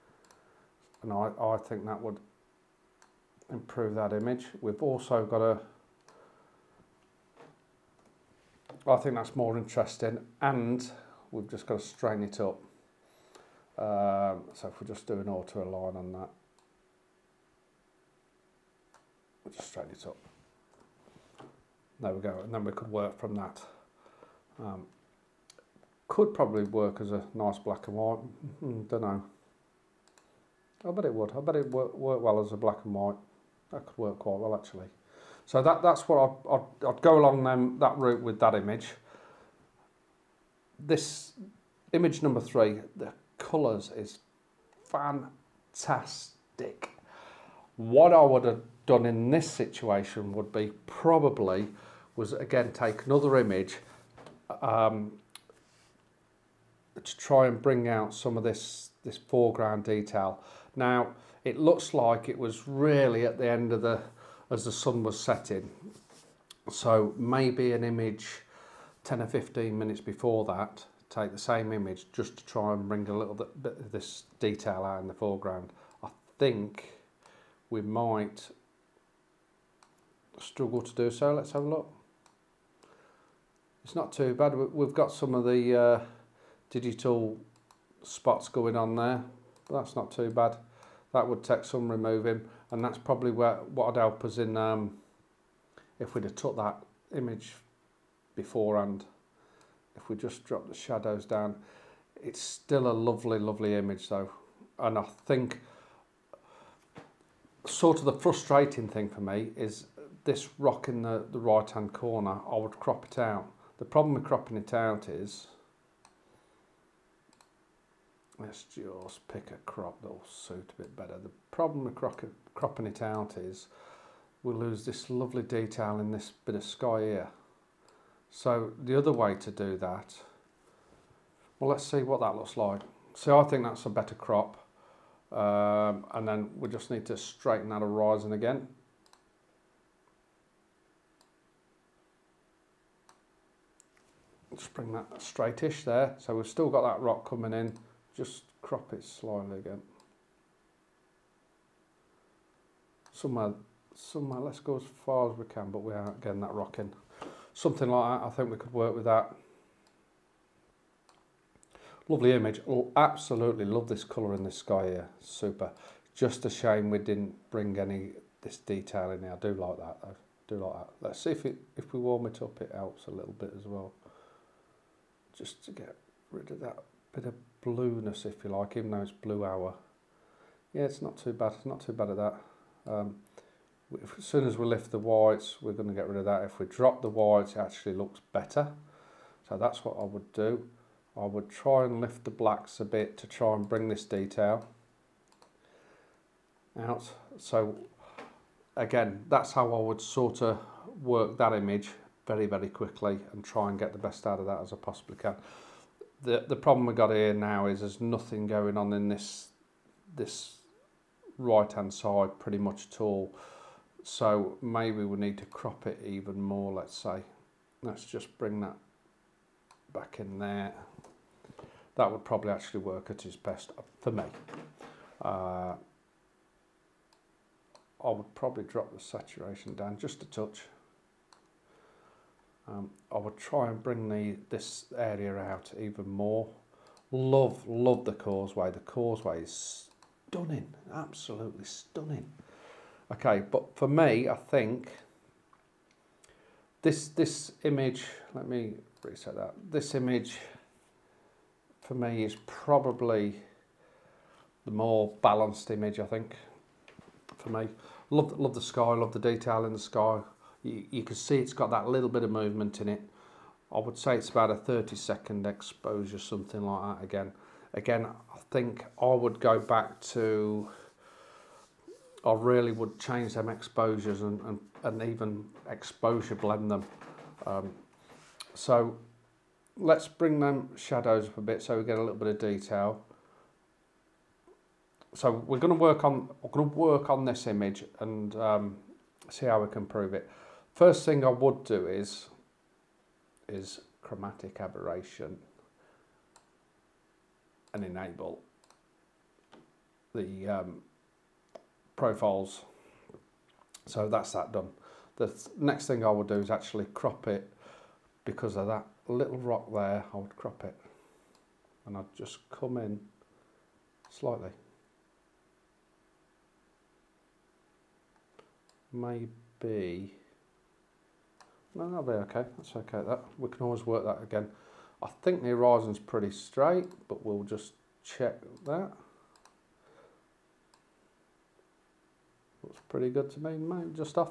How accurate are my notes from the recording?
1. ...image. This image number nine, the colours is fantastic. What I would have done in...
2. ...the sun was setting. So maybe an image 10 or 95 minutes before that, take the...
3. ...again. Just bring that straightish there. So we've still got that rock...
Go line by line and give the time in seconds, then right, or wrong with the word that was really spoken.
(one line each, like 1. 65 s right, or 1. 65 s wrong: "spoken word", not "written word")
1. 38 s wrong: "three", not "nine"
2. 64 s wrong: "15", not "95"
3. 138 s right.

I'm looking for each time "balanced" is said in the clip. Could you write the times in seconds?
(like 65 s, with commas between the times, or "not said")
255 s.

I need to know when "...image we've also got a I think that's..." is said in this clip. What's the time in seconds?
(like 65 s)
4 s.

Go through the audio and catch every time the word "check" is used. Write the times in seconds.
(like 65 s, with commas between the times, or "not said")
328 s.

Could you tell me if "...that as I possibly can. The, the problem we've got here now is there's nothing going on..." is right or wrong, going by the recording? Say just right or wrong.
right.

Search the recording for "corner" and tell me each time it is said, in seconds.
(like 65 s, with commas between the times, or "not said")
111 s.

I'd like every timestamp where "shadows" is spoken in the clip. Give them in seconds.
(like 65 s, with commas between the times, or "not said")
100 s, 280 s.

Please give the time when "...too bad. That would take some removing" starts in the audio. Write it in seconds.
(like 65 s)
90 s.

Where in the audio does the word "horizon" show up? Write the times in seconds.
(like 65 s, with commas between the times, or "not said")
137 s, 325 s.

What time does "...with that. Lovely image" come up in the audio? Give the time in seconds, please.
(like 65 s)
158 s.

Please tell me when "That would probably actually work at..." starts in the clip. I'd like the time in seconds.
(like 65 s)
221 s.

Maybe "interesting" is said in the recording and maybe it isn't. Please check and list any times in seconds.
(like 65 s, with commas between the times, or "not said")
9 s.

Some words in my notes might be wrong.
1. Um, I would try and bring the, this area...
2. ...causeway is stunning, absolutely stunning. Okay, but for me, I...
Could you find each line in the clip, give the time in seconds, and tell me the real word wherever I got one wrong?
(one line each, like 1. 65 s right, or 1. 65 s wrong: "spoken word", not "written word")
1. 232 s right
2. 238 s right.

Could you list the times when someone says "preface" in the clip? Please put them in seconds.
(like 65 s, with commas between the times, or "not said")
not said.